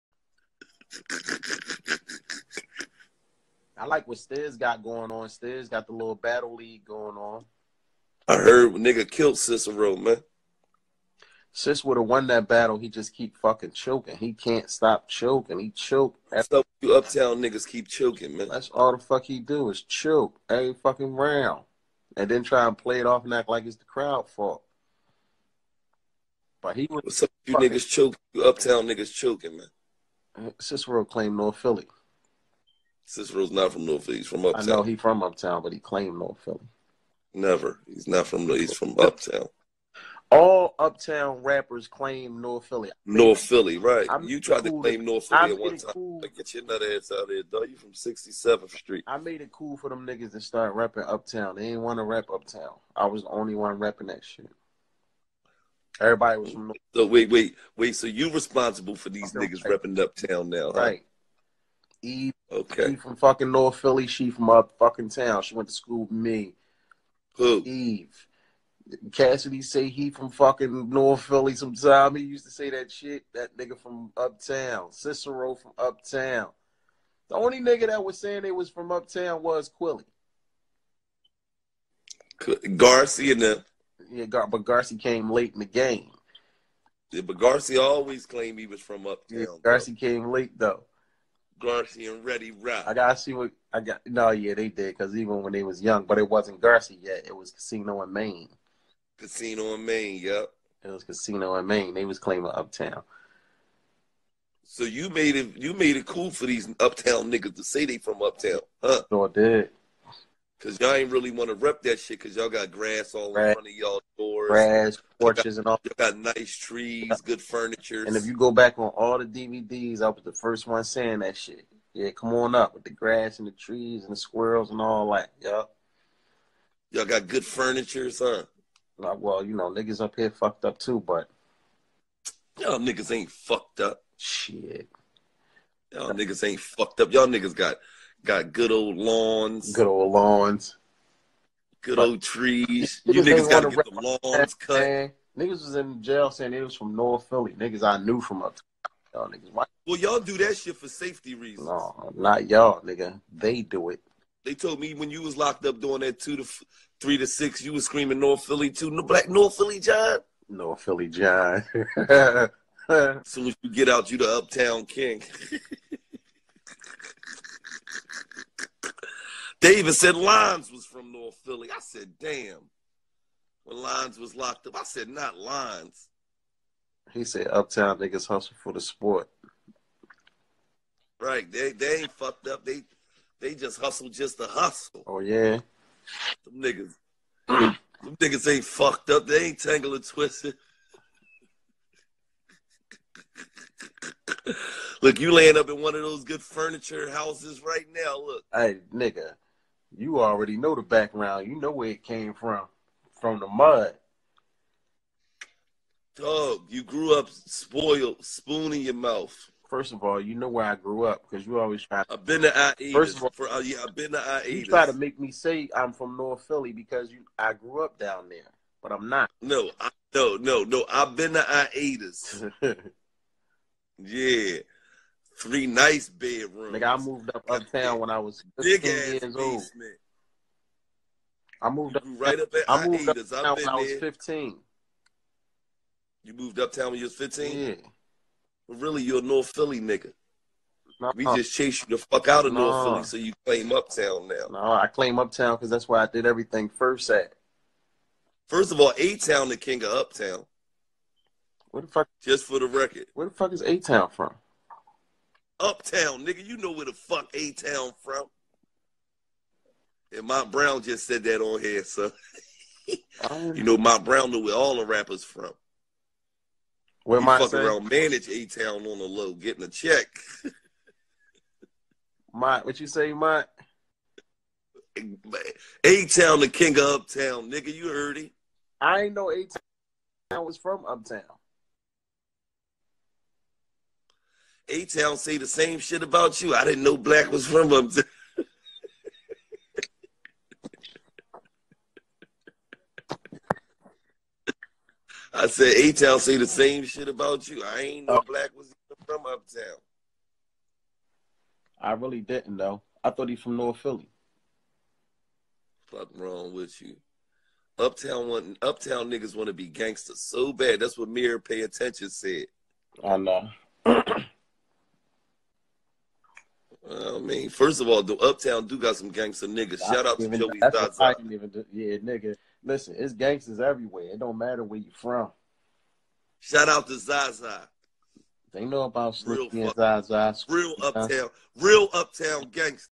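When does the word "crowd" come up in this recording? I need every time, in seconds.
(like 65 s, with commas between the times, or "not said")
23 s.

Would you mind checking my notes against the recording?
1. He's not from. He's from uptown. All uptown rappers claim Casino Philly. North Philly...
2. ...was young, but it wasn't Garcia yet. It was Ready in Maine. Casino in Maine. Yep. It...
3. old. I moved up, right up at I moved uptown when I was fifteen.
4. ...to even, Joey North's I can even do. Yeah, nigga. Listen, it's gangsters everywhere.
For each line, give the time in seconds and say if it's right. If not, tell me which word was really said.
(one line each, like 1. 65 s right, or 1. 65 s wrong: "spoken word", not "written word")
1. 37 s wrong: "North", not "Casino"
2. 95 s wrong: "Casino", not "Ready"
3. 229 s right
4. 320 s wrong: "That", not "North".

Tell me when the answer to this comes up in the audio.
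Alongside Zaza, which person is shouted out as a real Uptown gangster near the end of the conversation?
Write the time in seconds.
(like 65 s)
329 s.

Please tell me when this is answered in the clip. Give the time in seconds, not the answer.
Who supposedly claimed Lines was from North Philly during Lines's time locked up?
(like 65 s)
169 s.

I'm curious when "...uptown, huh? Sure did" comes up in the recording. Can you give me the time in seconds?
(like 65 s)
108 s.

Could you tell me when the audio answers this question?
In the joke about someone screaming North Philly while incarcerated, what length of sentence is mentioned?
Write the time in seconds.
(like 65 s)
156 s.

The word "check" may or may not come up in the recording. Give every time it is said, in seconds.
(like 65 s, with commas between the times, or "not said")
269 s.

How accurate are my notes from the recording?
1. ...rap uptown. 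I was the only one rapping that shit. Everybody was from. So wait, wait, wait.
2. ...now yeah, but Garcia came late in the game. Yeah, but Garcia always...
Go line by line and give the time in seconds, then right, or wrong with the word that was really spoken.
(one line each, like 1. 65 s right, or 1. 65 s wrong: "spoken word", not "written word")
1. 52 s right
2. 83 s right.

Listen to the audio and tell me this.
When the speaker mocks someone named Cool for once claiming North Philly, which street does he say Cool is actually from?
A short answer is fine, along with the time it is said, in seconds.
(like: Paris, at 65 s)
67th Street, at 47 s.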